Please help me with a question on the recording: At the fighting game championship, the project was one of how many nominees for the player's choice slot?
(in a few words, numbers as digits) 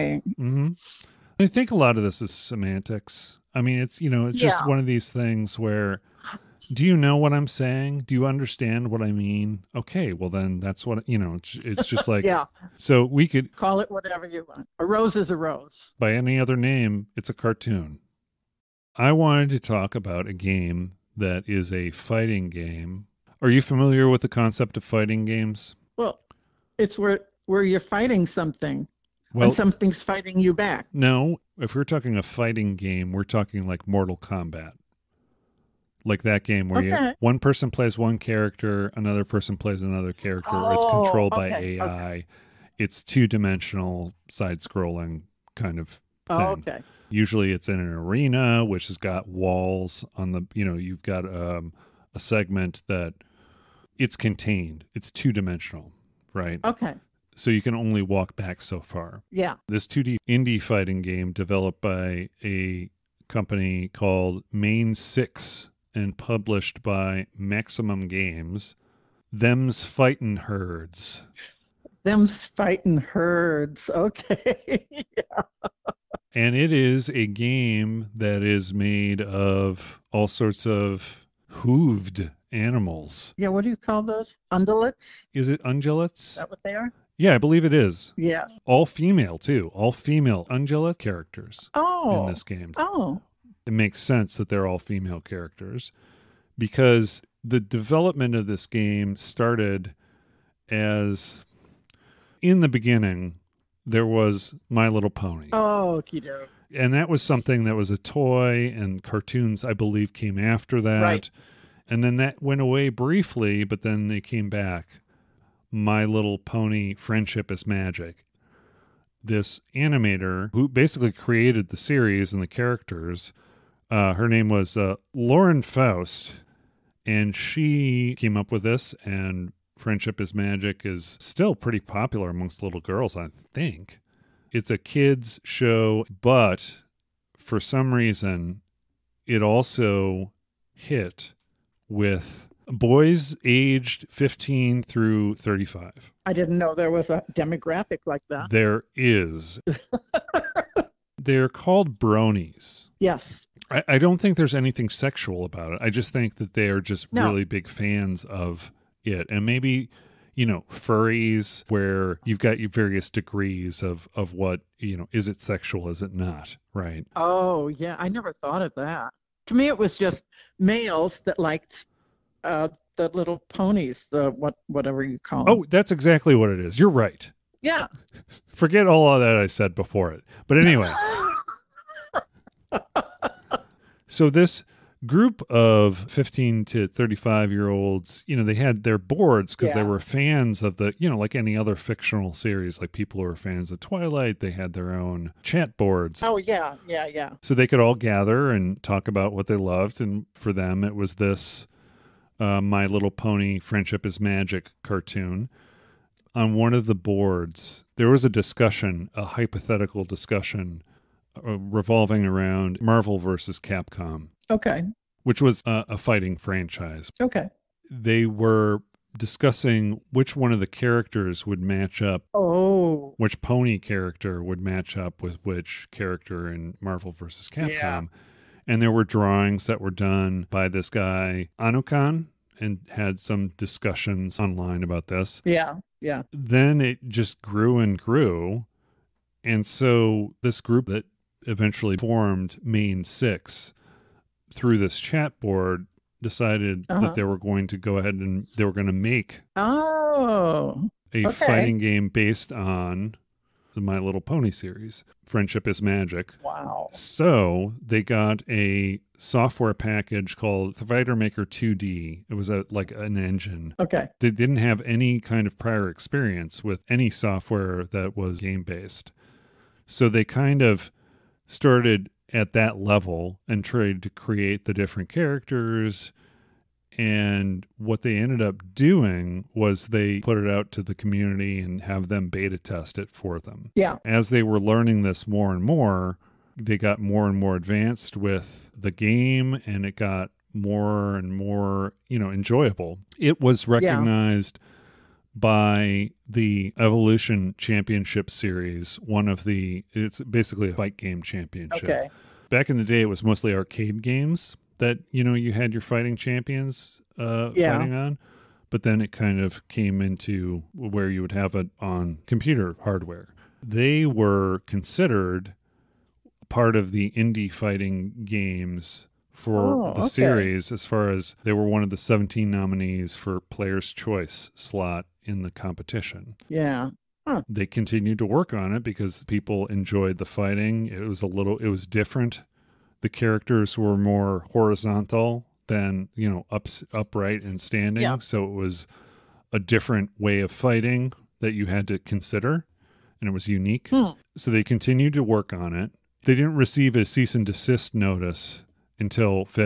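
17.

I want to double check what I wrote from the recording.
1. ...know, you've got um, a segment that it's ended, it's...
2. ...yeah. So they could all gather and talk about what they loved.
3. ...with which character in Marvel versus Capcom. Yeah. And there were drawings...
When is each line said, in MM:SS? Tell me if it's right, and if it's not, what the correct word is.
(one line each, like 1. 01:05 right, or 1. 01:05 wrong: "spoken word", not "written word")
1. 00:50 wrong: "contained", not "ended"
2. 03:17 right
3. 03:45 right.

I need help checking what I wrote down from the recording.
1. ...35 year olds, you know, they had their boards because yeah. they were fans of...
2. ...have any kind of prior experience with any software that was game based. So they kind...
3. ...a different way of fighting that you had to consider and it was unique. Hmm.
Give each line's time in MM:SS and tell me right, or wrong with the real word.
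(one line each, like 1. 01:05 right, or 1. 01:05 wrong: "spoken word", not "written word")
1. 03:06 right
2. 04:24 right
3. 05:39 right.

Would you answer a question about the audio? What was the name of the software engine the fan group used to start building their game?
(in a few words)
Fighter Maker 2D.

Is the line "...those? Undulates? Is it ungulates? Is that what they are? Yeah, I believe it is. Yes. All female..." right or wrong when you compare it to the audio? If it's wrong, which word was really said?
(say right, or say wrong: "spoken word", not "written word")
right.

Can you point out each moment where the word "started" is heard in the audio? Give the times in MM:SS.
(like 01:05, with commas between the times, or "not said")
01:39, 04:31.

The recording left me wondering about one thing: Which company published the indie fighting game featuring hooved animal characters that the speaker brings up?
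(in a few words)
Maximum Games.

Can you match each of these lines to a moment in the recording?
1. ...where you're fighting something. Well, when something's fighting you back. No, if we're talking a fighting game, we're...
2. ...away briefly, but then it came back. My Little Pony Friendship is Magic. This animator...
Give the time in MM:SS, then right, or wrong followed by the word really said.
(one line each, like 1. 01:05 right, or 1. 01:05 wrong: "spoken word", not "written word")
1. 00:27 right
2. 01:52 right.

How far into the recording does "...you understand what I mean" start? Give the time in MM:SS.
00:08.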